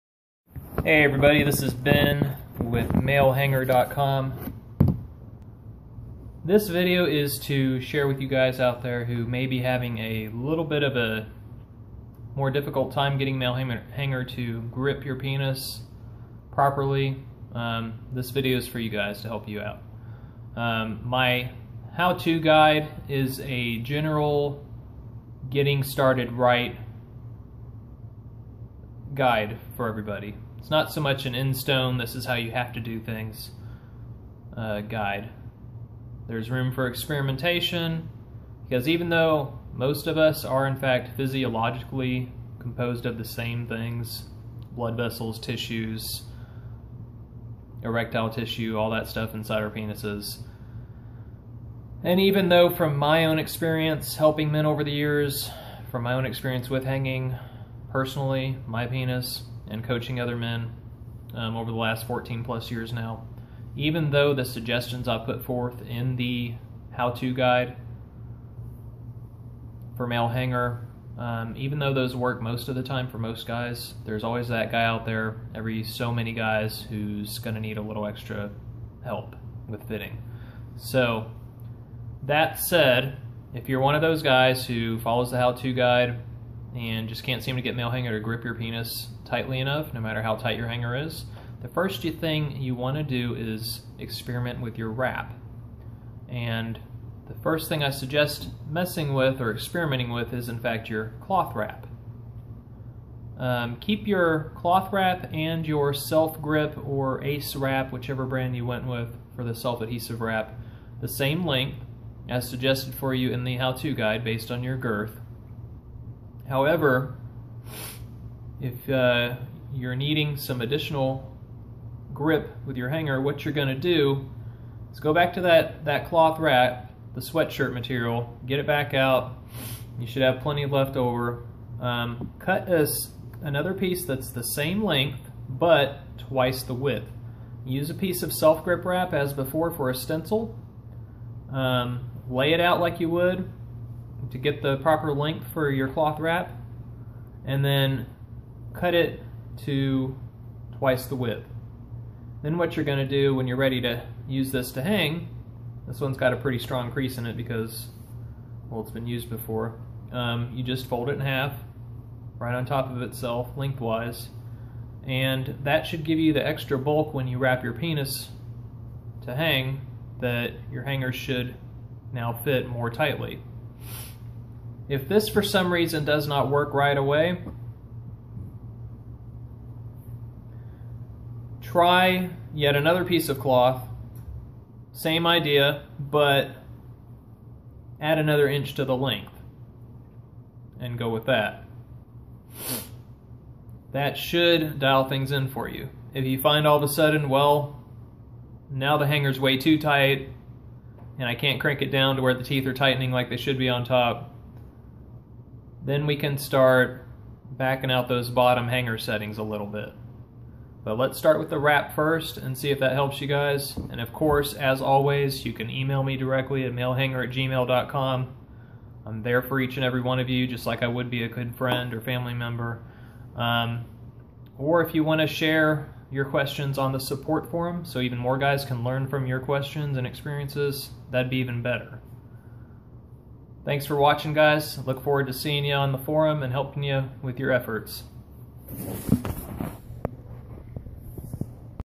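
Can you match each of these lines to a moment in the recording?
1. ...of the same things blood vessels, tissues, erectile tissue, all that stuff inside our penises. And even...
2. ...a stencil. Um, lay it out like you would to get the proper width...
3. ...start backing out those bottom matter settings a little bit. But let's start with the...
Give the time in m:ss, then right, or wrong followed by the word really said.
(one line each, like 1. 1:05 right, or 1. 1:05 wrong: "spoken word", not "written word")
1. 0:43 right
2. 2:19 wrong: "length", not "width"
3. 3:26 wrong: "hanger", not "matter".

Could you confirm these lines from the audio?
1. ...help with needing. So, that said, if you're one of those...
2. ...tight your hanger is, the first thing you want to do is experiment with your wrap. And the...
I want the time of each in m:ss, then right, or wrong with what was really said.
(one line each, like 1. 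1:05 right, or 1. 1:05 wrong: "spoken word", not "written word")
1. 1:19 wrong: "fitting", not "needing"
2. 1:30 right.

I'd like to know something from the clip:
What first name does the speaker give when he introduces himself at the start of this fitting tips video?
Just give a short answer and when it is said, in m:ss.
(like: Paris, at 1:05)
Ben, at 0:01.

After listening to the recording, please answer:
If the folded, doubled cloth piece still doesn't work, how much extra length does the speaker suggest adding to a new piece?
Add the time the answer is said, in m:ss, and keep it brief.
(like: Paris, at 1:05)
another inch, at 3:08.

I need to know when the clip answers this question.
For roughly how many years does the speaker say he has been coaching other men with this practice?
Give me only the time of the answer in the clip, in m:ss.
1:02.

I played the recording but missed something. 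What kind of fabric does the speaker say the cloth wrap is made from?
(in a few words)
sweatshirt material.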